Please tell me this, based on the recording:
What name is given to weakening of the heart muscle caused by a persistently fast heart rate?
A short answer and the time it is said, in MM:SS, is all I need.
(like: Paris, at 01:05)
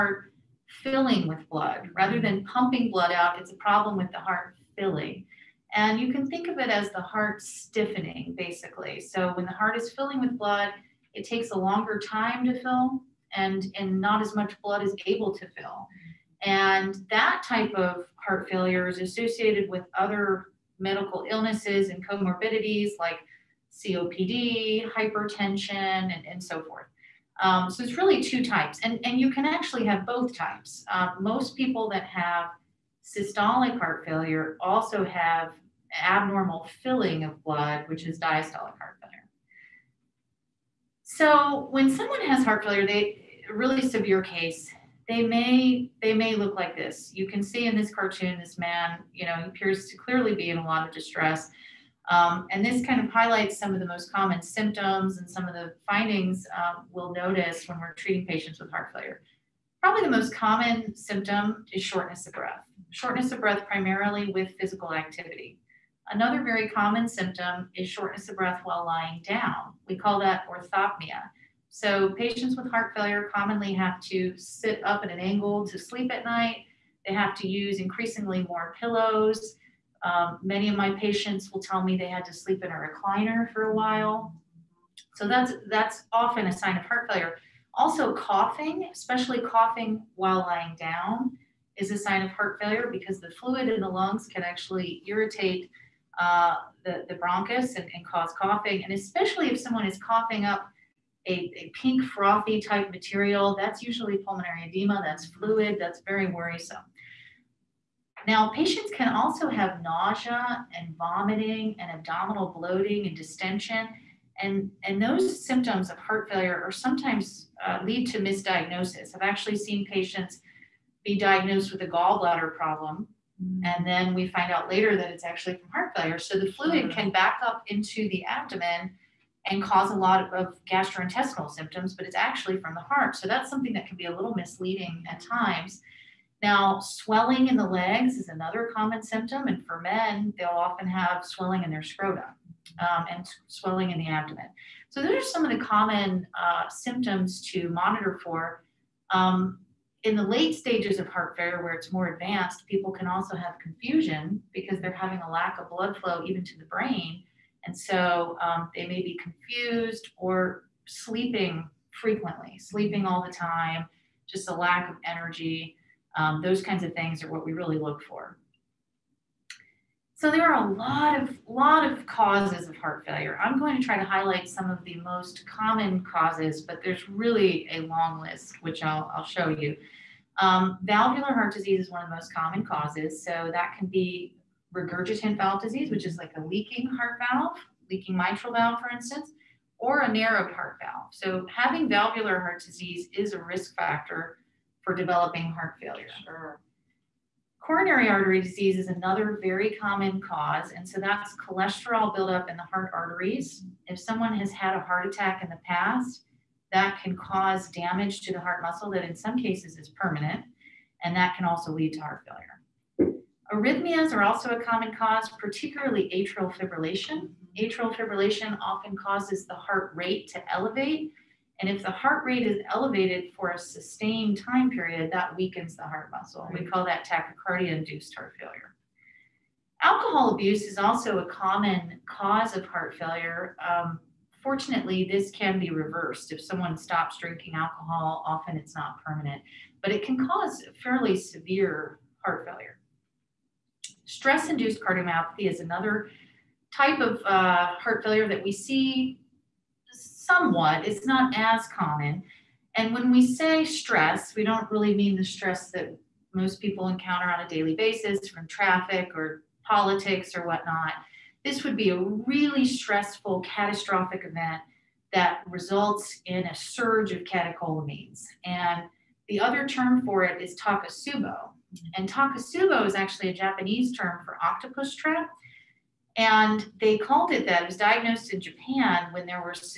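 Tachycardia induced heart failure, at 03:47.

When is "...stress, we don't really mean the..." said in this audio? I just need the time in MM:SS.
04:13.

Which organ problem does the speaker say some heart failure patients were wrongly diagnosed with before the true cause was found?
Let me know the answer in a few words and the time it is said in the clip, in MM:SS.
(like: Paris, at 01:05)
Gallbladder problem, at 02:01.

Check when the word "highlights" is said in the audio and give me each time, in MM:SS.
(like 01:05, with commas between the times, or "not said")
00:53, 02:54.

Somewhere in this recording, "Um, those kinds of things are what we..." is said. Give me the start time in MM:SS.
02:46.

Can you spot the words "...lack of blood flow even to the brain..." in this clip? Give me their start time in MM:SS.
02:35.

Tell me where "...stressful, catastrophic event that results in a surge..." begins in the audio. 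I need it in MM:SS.
04:22.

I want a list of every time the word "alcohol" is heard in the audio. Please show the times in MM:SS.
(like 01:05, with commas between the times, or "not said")
03:49, 03:57.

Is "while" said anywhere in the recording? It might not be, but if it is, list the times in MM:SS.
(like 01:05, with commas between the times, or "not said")
01:08, 01:23, 01:30.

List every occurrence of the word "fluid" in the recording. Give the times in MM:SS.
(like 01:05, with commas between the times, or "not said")
01:33, 01:45, 02:06.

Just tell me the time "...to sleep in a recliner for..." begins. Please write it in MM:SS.
01:22.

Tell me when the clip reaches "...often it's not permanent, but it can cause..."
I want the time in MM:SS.
03:58.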